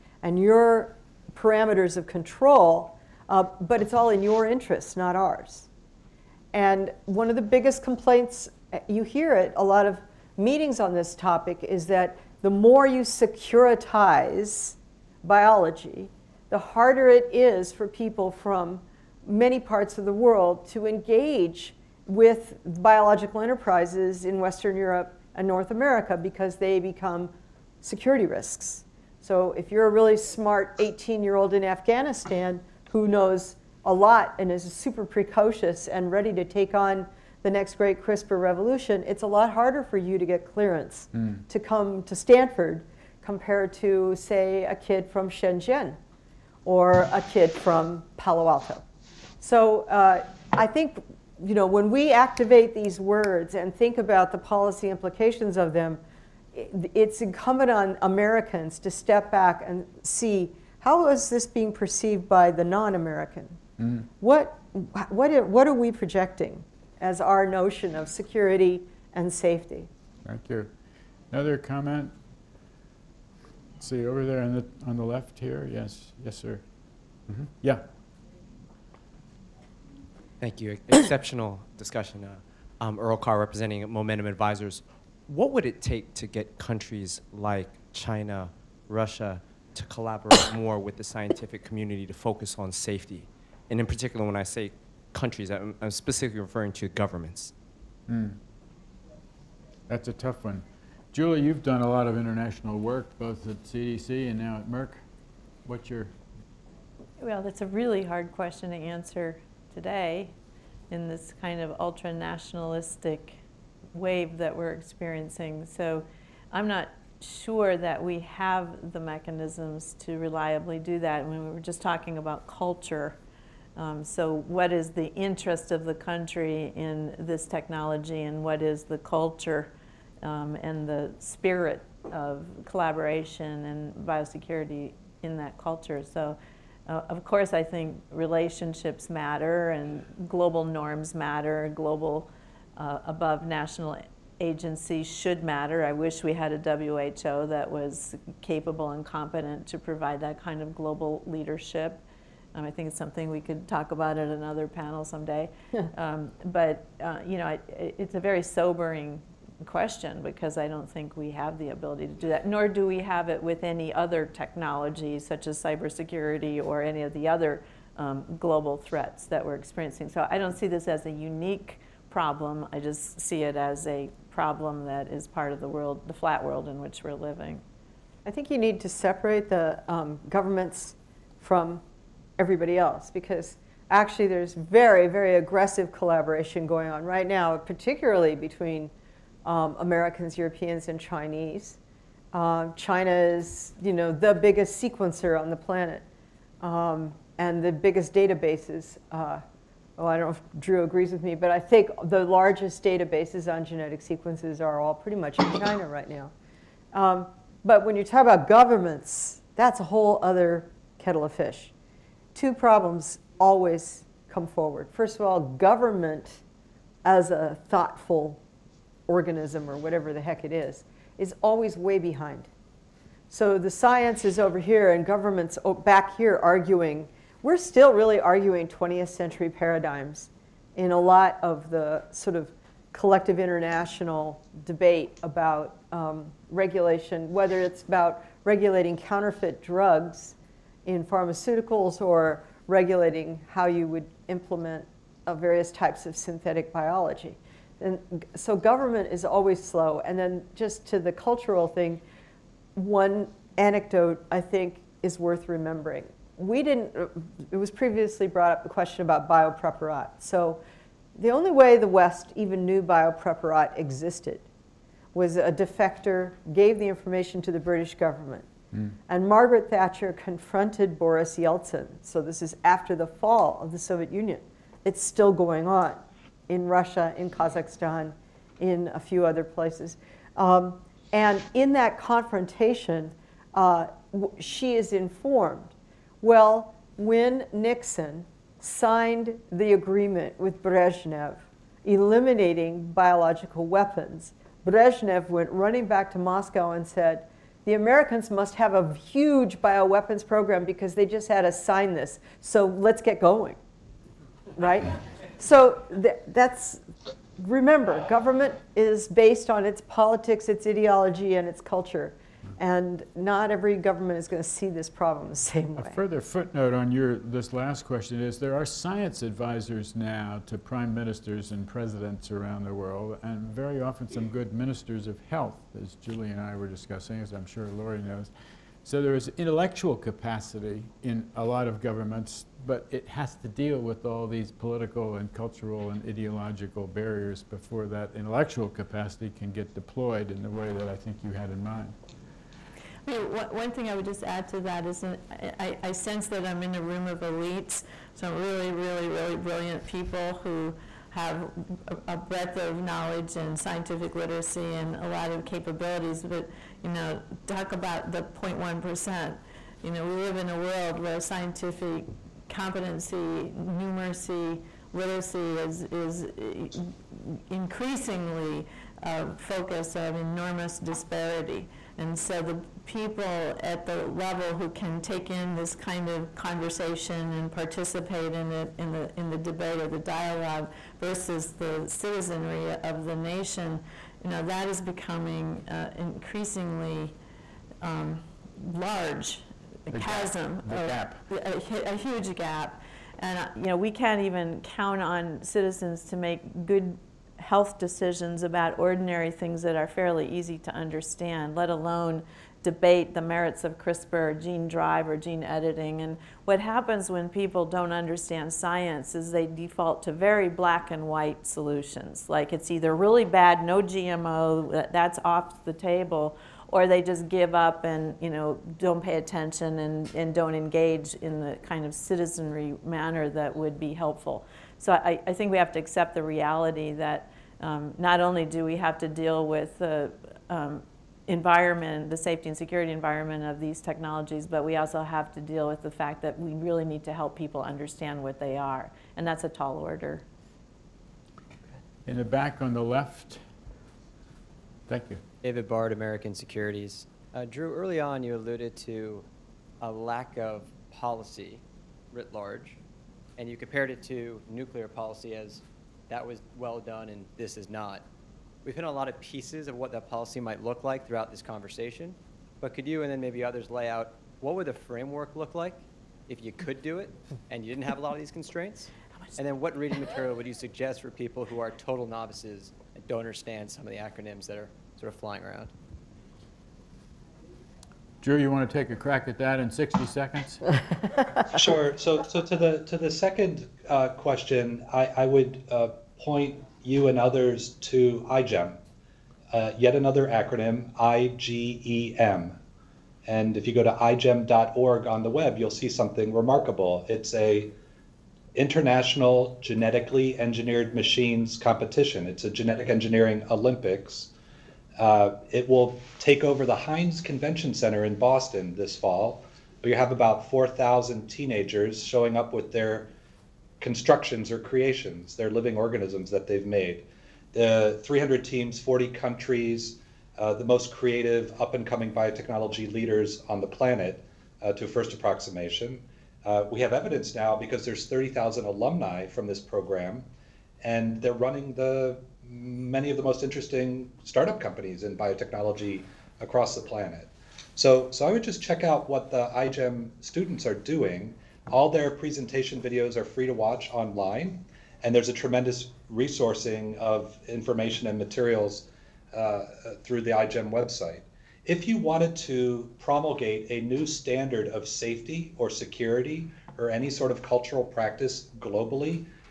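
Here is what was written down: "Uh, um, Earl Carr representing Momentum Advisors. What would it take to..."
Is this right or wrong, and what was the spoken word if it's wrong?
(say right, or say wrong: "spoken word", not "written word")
right.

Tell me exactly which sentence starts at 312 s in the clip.
And not every government is going to see this problem the same way.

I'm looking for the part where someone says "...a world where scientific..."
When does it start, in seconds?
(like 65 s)
360 s.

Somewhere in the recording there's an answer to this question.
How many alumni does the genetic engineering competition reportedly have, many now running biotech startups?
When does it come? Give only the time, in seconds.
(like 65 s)
528 s.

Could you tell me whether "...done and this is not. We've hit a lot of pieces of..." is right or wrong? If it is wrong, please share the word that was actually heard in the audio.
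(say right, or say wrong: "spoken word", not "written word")
right.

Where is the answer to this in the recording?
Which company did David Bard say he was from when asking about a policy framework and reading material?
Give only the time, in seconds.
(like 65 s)
445 s.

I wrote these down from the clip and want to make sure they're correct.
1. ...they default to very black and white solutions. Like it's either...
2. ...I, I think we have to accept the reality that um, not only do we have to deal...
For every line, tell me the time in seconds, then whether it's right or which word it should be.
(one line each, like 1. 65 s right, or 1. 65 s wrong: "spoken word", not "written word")
1. 409 s right
2. 424 s right.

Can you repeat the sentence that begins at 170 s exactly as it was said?
So I don't see this as a unique problem.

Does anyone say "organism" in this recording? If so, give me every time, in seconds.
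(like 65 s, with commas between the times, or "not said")
219 s, 515 s.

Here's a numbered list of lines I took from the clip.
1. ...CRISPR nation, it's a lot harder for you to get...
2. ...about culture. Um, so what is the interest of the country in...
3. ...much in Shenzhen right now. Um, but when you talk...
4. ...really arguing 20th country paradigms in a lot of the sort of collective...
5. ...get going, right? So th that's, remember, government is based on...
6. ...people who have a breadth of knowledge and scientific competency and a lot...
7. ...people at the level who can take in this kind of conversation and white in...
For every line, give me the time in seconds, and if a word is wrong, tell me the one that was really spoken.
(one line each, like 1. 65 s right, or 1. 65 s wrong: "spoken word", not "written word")
1. 38 s wrong: "revolution", not "nation"
2. 122 s right
3. 205 s wrong: "China", not "Shenzhen"
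4. 227 s wrong: "century", not "country"
5. 303 s right
6. 349 s wrong: "literacy", not "competency"
7. 372 s wrong: "participate", not "white".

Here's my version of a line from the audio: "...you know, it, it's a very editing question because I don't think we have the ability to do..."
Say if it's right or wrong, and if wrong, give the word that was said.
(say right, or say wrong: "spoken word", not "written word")
wrong: "sobering", not "editing".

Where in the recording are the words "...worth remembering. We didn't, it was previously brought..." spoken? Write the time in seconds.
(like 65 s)
255 s.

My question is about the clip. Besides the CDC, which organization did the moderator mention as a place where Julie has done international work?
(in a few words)
Merck.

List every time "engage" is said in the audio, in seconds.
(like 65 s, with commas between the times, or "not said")
20 s, 420 s.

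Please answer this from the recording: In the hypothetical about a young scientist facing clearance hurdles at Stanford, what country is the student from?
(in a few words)
Afghanistan.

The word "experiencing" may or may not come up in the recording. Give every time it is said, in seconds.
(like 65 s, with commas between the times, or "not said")
114 s, 169 s.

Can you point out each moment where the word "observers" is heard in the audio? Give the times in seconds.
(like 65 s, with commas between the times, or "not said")
not said.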